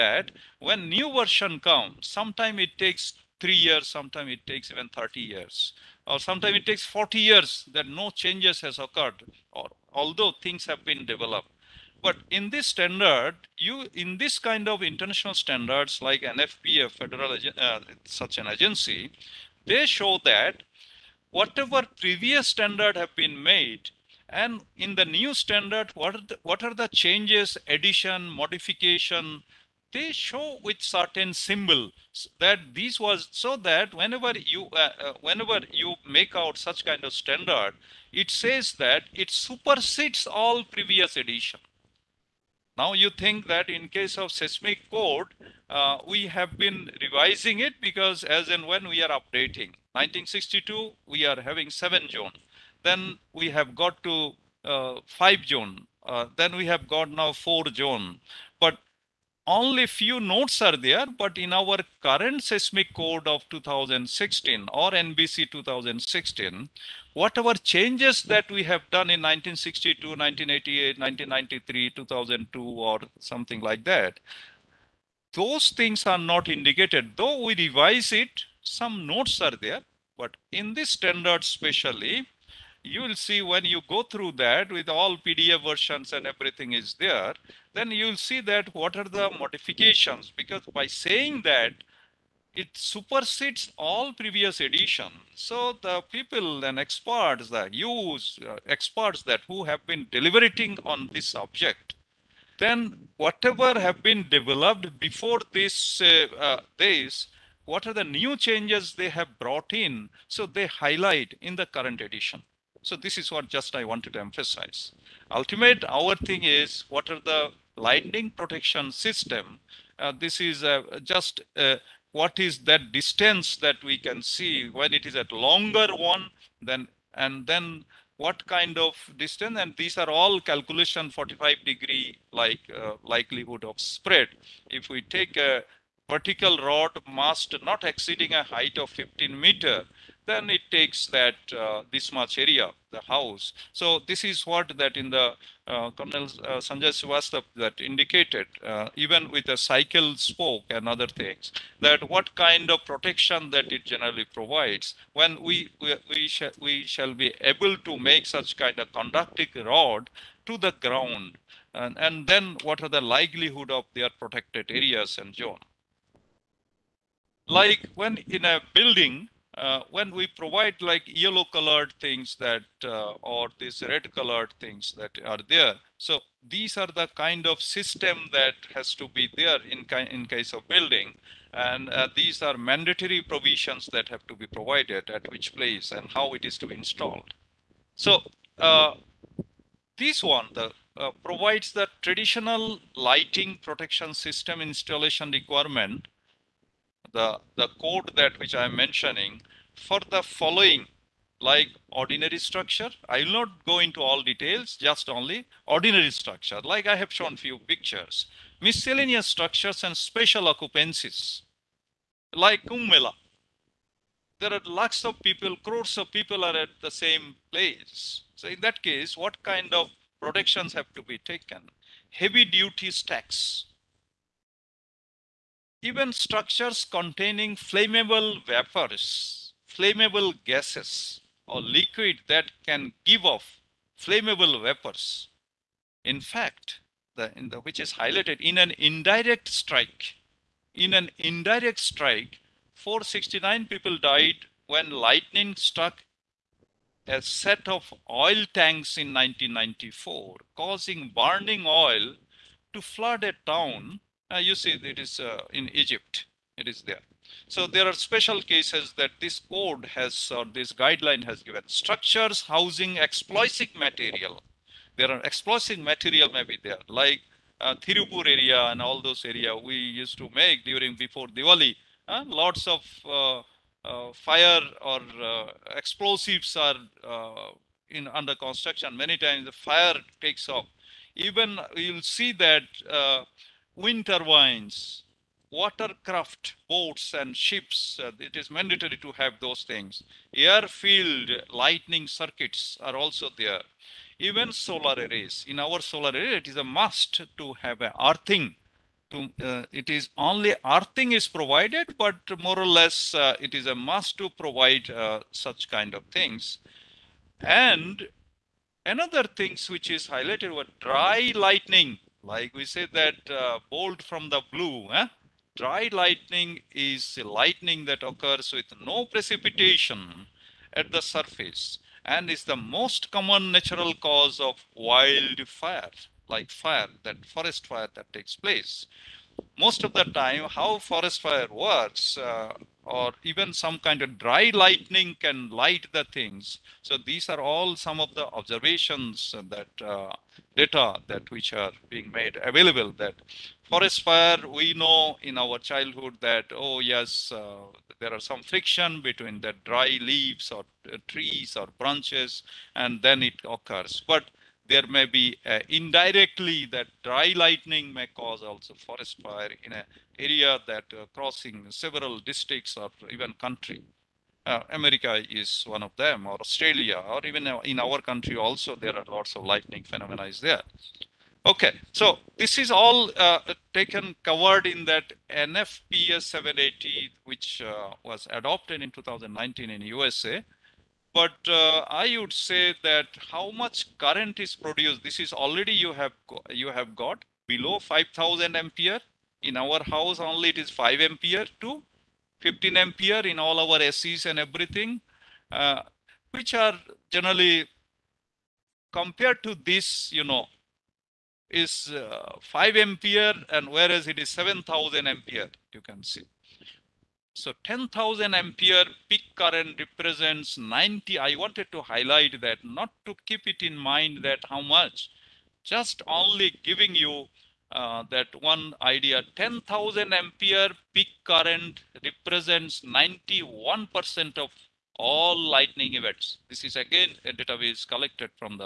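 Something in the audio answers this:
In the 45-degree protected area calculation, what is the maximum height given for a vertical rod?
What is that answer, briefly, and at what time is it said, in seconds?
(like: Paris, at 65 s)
15 meters, at 138 s.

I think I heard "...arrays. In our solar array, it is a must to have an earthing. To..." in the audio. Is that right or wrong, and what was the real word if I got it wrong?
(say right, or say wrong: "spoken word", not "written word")
right.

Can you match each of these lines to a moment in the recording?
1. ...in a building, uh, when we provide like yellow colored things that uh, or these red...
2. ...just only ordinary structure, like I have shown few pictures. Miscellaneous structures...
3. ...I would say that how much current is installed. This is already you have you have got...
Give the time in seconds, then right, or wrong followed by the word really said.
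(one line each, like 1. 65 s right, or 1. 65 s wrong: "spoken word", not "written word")
1. 168 s right
2. 204 s right
3. 382 s wrong: "produced", not "installed".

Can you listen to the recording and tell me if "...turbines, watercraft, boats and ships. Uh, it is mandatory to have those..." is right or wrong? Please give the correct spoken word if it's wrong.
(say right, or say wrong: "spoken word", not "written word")
right.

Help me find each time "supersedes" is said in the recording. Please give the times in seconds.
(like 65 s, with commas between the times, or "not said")
39 s, 92 s.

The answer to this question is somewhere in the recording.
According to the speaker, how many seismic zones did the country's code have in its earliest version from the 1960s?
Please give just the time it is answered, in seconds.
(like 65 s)
51 s.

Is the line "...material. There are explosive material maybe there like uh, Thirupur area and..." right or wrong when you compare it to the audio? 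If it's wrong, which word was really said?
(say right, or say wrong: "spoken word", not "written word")
right.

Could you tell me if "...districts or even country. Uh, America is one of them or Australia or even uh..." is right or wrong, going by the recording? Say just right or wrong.
right.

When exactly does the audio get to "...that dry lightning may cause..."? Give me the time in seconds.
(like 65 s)
356 s.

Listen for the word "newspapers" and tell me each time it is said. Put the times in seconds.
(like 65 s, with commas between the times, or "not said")
not said.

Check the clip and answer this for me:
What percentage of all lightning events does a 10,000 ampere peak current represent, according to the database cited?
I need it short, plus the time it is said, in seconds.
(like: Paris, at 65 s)
91%, at 422 s.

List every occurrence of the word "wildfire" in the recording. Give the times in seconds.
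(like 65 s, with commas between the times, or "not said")
324 s.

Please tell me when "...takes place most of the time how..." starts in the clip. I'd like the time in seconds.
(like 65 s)
328 s.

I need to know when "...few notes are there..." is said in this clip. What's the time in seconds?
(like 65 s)
59 s.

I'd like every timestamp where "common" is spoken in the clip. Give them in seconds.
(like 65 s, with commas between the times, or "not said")
323 s.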